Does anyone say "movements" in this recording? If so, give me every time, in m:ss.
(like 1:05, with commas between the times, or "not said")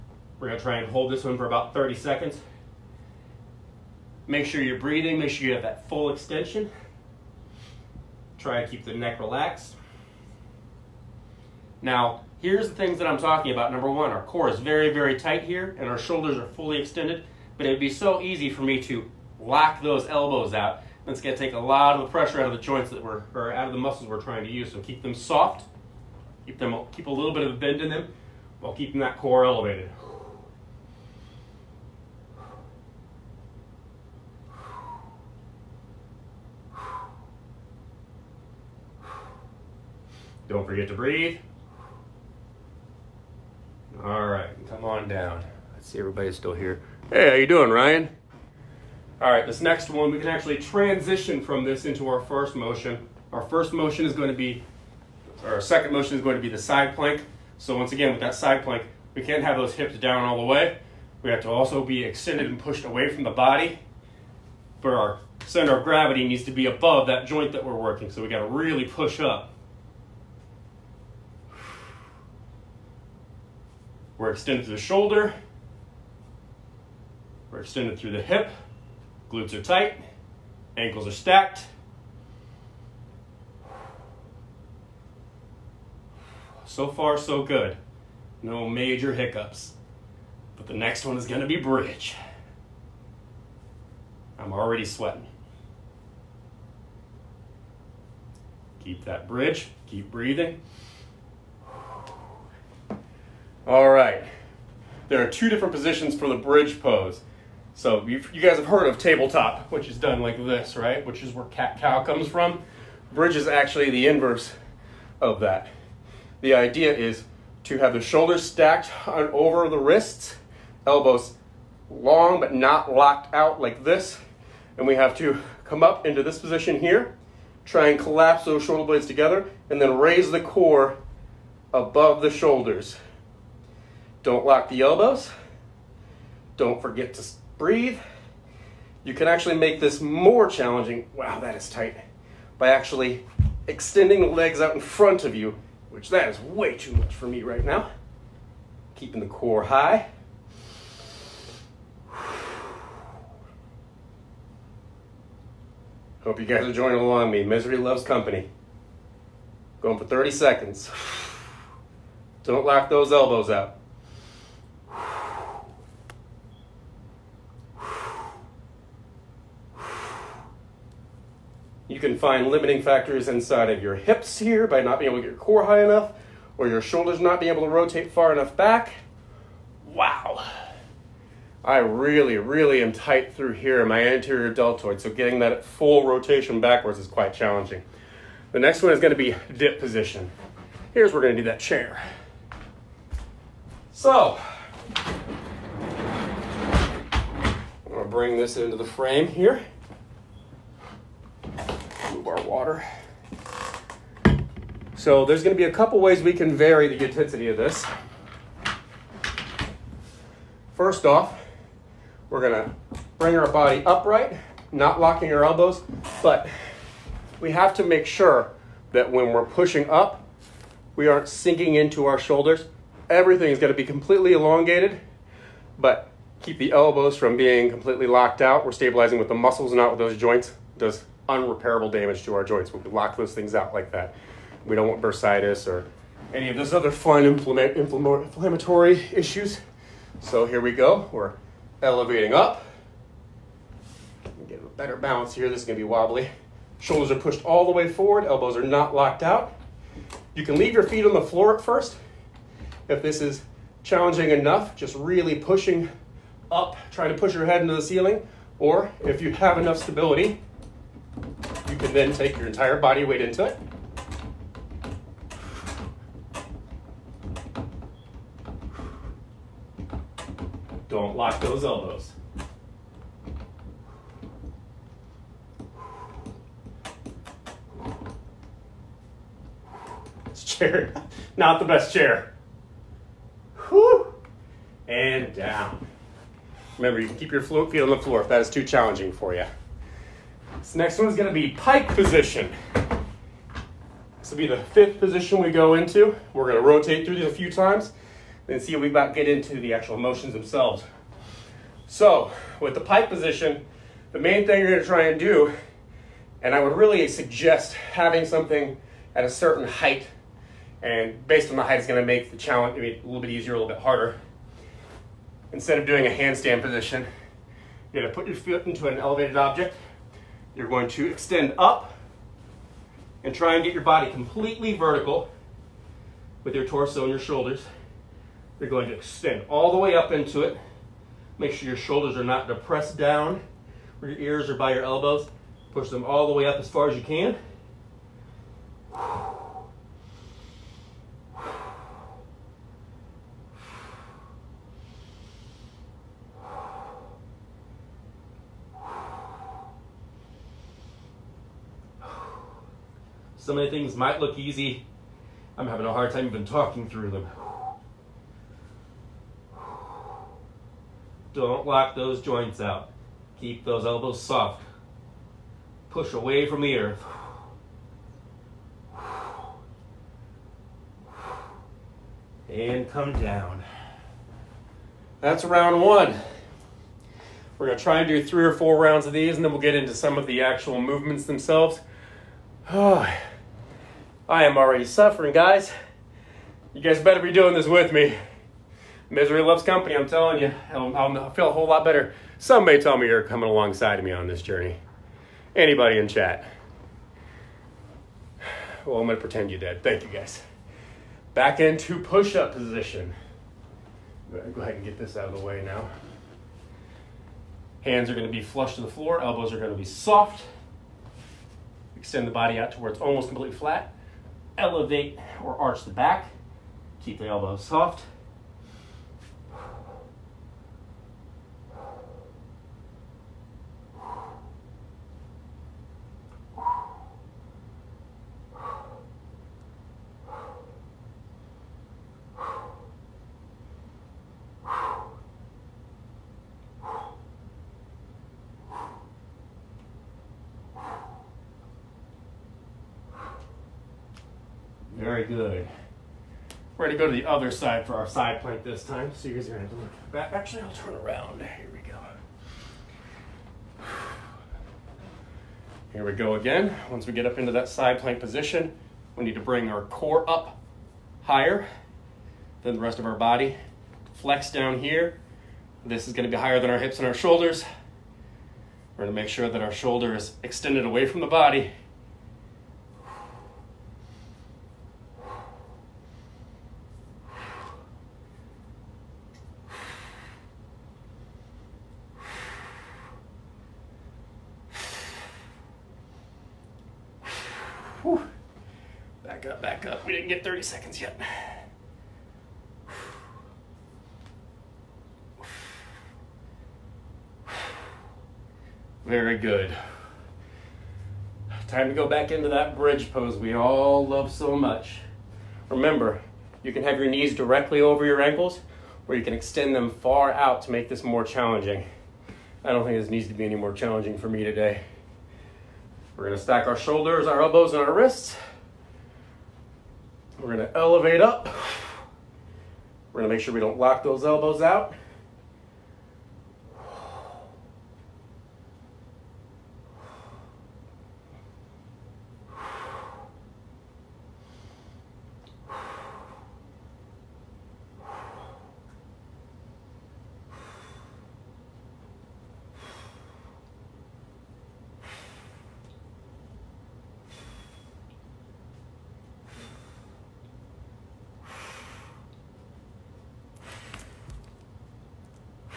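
6:20.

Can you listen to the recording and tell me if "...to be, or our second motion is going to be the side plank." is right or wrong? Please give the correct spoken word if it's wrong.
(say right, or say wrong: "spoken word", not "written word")
right.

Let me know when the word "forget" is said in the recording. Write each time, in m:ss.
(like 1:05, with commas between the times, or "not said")
0:40, 2:16.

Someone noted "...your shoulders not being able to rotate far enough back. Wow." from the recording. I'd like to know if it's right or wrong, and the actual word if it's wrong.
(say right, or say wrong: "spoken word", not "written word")
right.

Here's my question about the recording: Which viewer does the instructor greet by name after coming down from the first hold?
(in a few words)
Ryan.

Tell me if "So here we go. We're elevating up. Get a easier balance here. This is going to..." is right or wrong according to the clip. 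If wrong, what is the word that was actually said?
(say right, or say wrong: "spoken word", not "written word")
wrong: "better", not "easier".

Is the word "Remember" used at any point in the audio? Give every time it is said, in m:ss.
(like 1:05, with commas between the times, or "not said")
4:46, 8:25.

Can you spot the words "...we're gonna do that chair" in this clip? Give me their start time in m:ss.
3:11.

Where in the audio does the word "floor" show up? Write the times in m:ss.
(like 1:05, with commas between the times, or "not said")
4:11, 4:47, 6:48.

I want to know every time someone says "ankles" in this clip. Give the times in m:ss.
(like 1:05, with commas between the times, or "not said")
1:20, 8:28.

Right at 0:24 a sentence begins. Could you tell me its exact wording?
So keep them soft, keep them, keep a little bit of a bend in them, while keeping that core elevated.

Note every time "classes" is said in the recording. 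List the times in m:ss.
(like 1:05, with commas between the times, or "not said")
not said.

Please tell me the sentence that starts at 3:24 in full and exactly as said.
So there's going to be a couple ways we can vary the intensity of this.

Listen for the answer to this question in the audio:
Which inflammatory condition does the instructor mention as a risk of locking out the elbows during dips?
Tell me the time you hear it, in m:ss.
3:55.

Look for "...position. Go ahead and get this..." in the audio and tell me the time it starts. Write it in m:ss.
6:42.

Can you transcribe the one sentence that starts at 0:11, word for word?
Now, here's the things that I'm talking about.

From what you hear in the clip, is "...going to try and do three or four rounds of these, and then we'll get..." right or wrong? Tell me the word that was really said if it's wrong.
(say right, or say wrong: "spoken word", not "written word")
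right.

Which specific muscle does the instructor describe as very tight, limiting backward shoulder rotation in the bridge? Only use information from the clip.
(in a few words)
Anterior deltoid.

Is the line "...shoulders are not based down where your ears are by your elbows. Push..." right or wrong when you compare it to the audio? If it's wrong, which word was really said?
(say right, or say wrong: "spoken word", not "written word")
wrong: "depressed", not "based".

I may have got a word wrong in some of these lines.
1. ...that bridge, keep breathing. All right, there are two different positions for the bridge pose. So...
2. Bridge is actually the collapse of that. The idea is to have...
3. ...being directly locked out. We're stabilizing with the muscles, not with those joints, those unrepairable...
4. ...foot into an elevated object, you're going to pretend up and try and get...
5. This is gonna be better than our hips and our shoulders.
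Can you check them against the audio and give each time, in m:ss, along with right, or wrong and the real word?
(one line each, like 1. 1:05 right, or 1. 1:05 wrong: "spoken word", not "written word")
1. 1:39 right
2. 1:53 wrong: "inverse", not "collapse"
3. 3:47 wrong: "completely", not "directly"
4. 5:18 wrong: "extend", not "pretend"
5. 7:45 wrong: "higher", not "better".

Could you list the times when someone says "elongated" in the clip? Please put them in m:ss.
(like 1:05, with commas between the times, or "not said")
3:44.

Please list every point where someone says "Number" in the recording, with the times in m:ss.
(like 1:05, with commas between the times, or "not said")
0:13.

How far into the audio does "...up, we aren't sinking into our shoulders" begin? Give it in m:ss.
3:39.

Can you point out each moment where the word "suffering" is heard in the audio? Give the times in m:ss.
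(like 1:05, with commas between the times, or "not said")
6:24.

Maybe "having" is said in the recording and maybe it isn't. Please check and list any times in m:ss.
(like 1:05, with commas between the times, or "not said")
5:07, 5:55.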